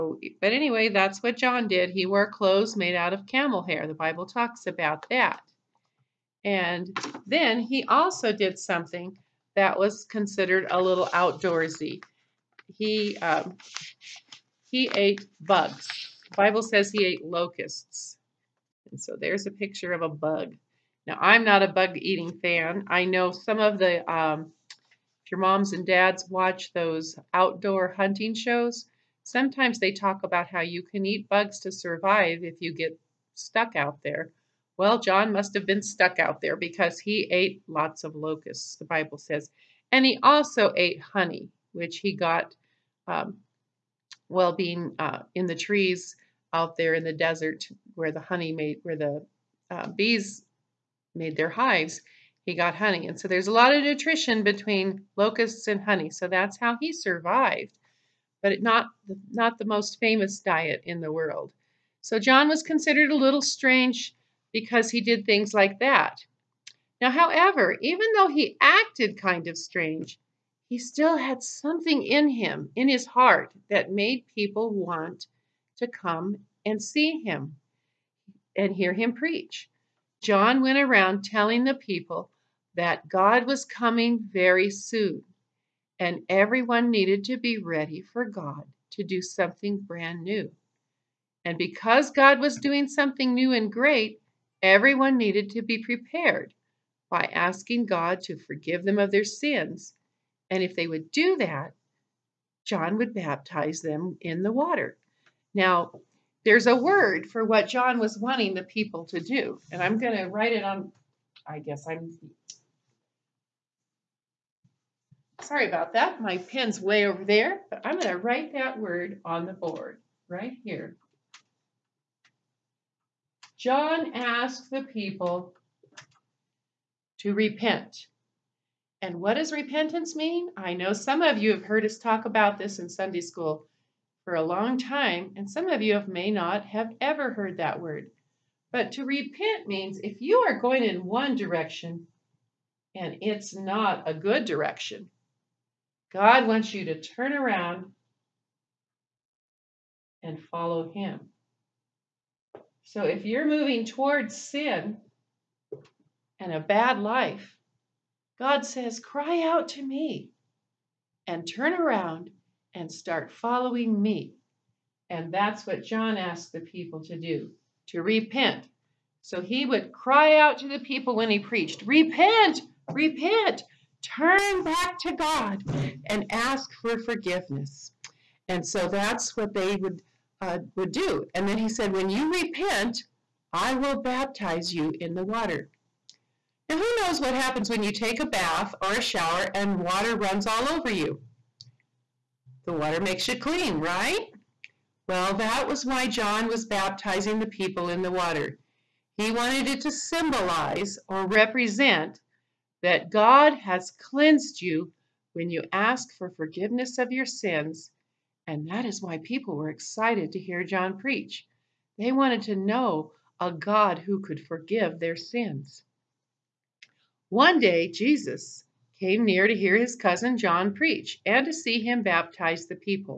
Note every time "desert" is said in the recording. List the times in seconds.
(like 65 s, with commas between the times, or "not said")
47 s.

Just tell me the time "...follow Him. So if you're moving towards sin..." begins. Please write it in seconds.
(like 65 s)
150 s.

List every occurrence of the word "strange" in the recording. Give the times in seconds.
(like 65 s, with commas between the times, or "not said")
63 s, 69 s.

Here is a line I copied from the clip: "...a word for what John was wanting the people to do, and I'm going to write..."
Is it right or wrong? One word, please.
right.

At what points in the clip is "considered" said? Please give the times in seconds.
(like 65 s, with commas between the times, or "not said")
10 s, 62 s.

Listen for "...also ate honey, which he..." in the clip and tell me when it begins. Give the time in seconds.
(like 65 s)
40 s.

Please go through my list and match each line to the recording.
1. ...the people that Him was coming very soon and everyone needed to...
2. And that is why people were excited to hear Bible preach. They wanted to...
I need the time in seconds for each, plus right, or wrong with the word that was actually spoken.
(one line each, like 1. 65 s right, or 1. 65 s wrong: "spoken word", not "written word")
1. 81 s wrong: "God", not "Him"
2. 208 s wrong: "John", not "Bible".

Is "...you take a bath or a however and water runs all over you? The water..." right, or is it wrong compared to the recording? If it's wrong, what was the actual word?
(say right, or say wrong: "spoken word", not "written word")
wrong: "shower", not "however".